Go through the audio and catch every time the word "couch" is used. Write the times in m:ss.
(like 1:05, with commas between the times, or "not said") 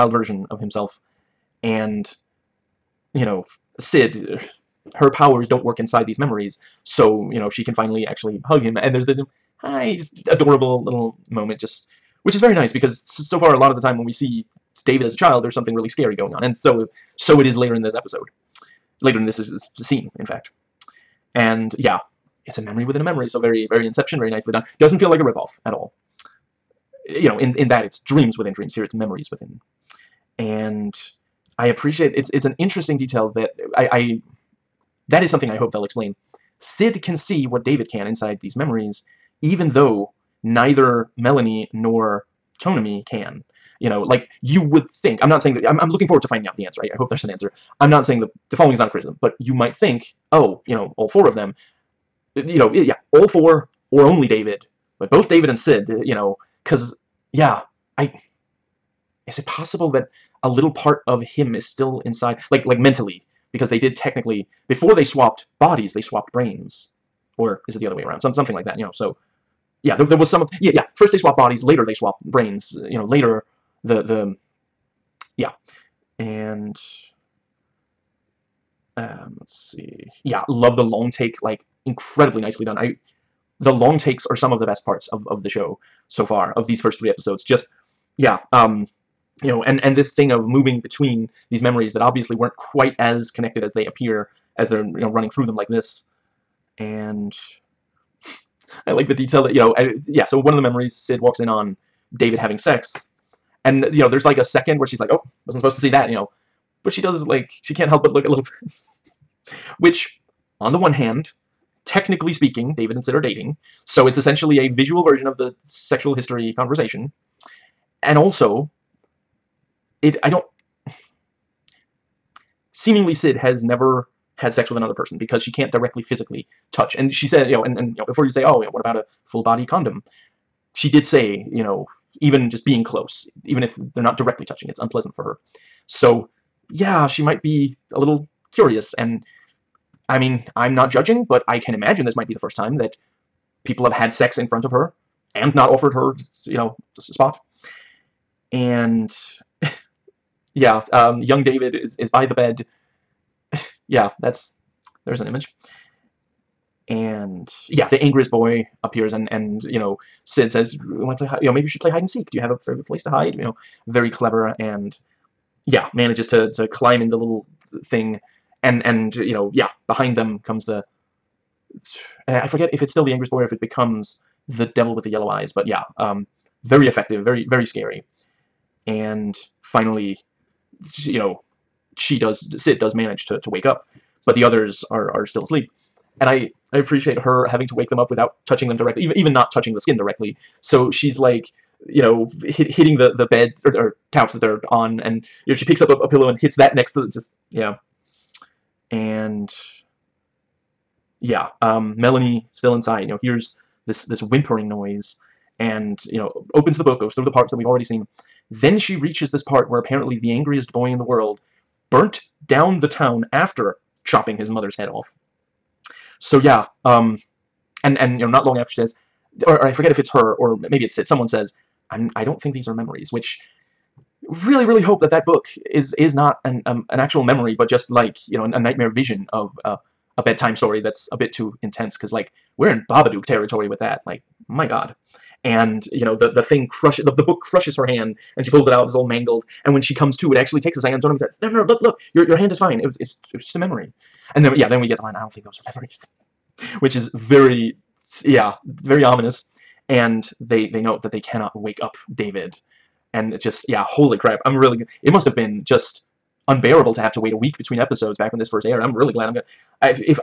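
3:14.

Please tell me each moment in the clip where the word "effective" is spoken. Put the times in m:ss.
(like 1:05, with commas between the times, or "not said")
2:56.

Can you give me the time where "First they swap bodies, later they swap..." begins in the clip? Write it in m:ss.
1:10.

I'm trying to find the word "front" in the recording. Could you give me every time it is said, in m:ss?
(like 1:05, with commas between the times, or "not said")
2:24.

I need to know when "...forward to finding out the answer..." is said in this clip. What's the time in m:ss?
0:46.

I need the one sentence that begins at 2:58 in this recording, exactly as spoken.
And finally, you know, she does, Syd does manage to, to wake up, but the others are, are still asleep.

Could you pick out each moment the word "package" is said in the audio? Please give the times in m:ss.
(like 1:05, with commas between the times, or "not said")
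not said.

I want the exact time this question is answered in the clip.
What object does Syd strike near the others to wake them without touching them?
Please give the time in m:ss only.
3:16.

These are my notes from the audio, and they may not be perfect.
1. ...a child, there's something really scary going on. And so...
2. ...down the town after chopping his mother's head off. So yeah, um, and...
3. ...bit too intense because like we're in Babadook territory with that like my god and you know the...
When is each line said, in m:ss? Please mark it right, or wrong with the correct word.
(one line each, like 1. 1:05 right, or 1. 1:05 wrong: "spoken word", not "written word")
1. 0:15 right
2. 3:32 right
3. 3:51 right.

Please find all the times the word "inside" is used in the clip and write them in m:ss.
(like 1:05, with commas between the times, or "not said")
0:05, 0:38, 1:02, 3:22.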